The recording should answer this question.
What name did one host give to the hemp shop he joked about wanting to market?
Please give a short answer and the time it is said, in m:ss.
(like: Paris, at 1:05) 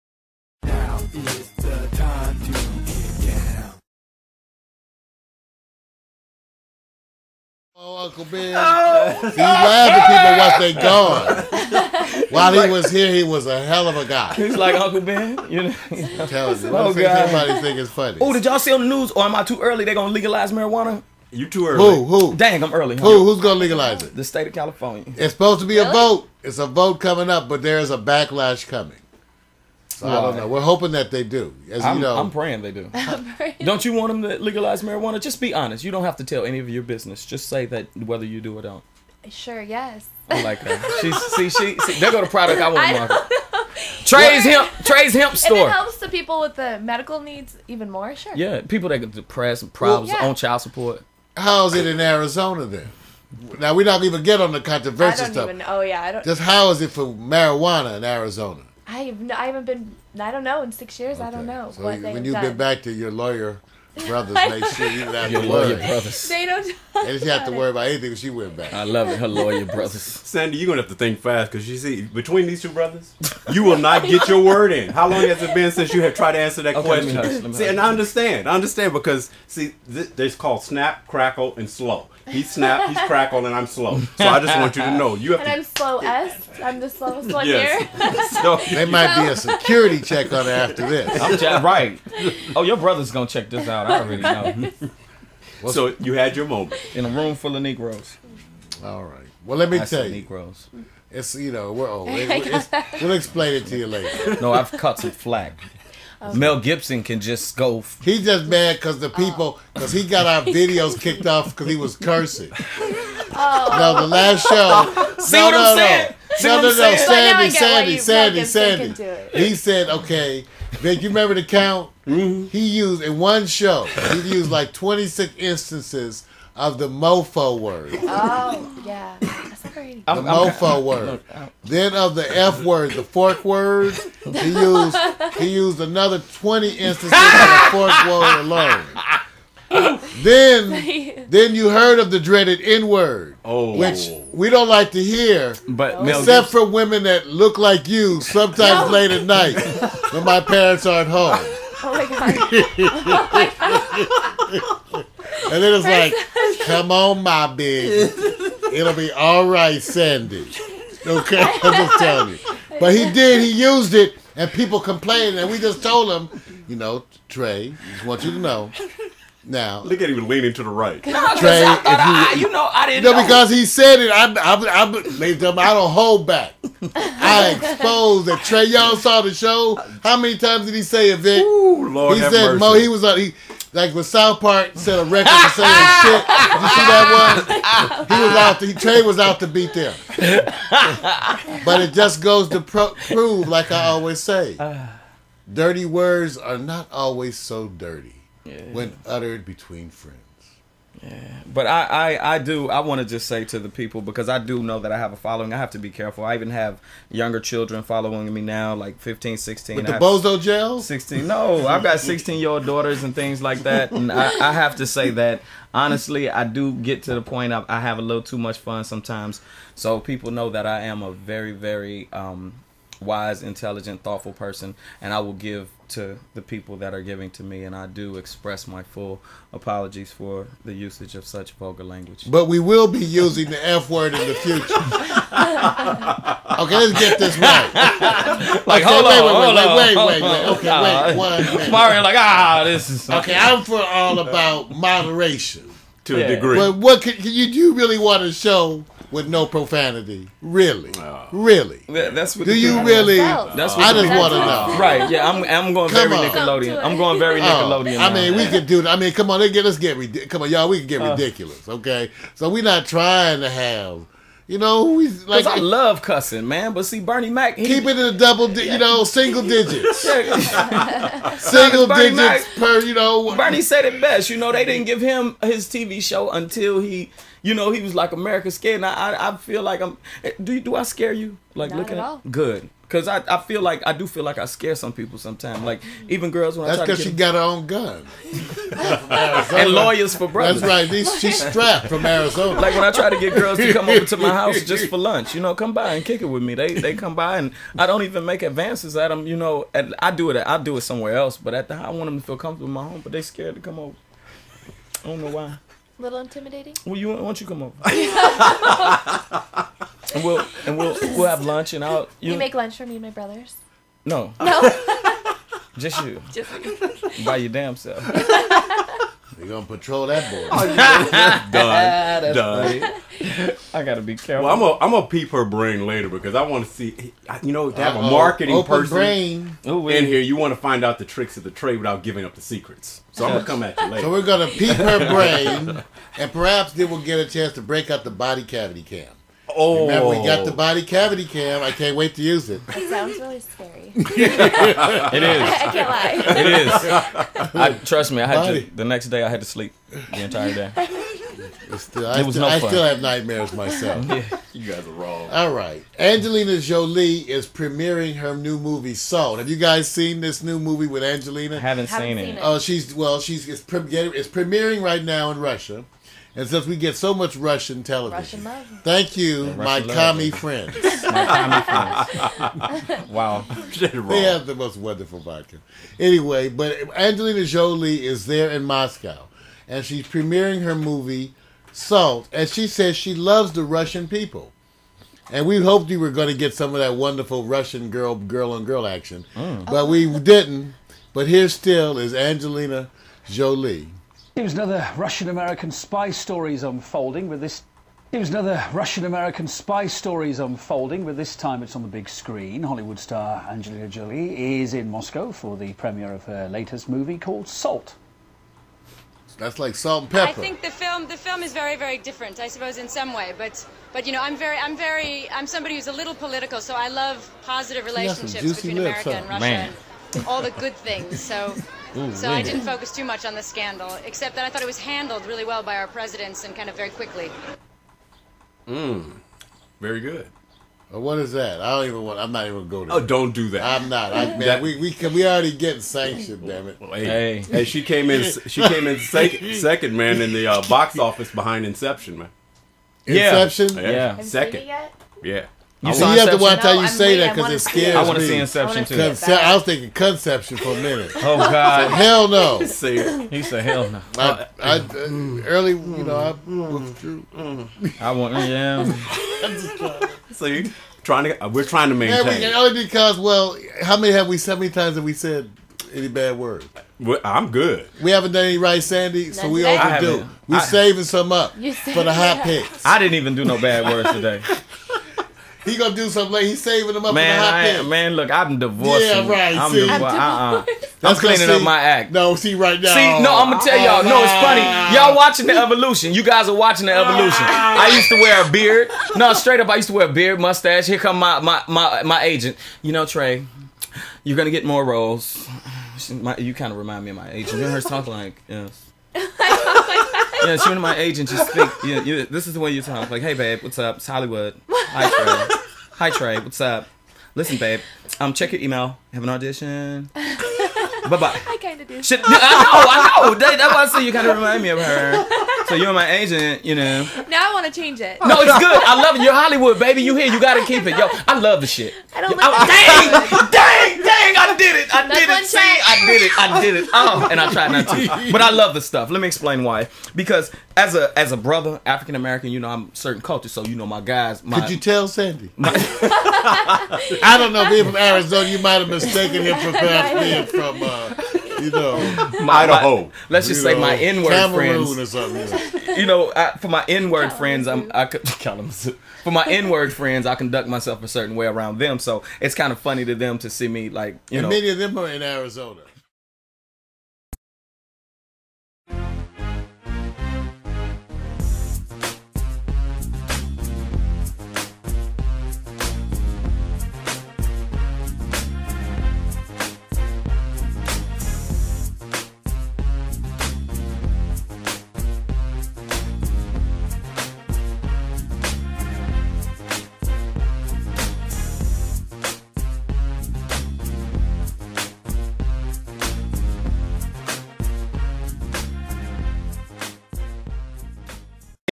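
Trey's hemp store, at 0:44.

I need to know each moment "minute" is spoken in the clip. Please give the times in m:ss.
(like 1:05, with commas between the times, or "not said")
4:01, 7:30.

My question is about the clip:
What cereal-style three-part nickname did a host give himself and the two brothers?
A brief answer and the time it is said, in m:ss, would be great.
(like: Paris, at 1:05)
Snap, crackle, and slow, at 1:20.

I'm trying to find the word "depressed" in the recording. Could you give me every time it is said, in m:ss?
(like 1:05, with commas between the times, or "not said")
0:49.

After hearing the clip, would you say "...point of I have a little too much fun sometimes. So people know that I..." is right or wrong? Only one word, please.
right.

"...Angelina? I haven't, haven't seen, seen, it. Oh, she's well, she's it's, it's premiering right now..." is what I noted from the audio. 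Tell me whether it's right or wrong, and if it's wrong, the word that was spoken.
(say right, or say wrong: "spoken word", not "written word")
right.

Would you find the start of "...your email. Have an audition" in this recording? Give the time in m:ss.
8:28.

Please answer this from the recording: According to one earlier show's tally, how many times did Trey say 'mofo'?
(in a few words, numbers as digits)
26.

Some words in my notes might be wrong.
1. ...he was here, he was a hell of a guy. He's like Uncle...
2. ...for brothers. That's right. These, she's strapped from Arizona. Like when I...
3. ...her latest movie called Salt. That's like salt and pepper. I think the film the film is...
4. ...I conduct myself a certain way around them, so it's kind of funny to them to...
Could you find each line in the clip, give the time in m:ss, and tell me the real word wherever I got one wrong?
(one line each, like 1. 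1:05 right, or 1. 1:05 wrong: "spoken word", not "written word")
1. 0:12 right
2. 4:50 right
3. 6:46 right
4. 9:10 right.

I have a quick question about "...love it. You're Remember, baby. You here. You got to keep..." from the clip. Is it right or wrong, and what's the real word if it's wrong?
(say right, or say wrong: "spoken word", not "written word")
wrong: "Hollywood", not "Remember".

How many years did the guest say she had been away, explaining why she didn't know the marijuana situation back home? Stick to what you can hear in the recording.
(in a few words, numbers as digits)
6.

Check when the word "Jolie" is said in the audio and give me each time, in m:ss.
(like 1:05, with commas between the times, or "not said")
5:56, 6:17, 6:33, 6:43.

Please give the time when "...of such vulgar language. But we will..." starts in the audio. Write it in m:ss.
3:51.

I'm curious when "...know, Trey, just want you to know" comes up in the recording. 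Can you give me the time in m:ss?
2:46.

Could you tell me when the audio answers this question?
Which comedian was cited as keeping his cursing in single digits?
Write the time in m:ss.
4:26.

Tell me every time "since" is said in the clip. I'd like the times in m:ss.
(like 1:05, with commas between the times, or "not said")
1:15, 6:06.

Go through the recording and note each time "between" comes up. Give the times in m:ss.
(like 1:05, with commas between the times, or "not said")
1:12, 3:19, 6:58.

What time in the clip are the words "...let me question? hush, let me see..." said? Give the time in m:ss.
1:16.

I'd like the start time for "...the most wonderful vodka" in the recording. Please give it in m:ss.
6:14.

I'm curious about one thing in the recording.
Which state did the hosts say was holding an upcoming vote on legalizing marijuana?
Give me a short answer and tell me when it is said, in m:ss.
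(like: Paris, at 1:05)
California, at 0:24.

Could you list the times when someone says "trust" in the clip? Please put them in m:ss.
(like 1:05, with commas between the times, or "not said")
5:47.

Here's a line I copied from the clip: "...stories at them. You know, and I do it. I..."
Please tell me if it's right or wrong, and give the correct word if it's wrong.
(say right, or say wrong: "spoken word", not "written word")
wrong: "advances", not "stories".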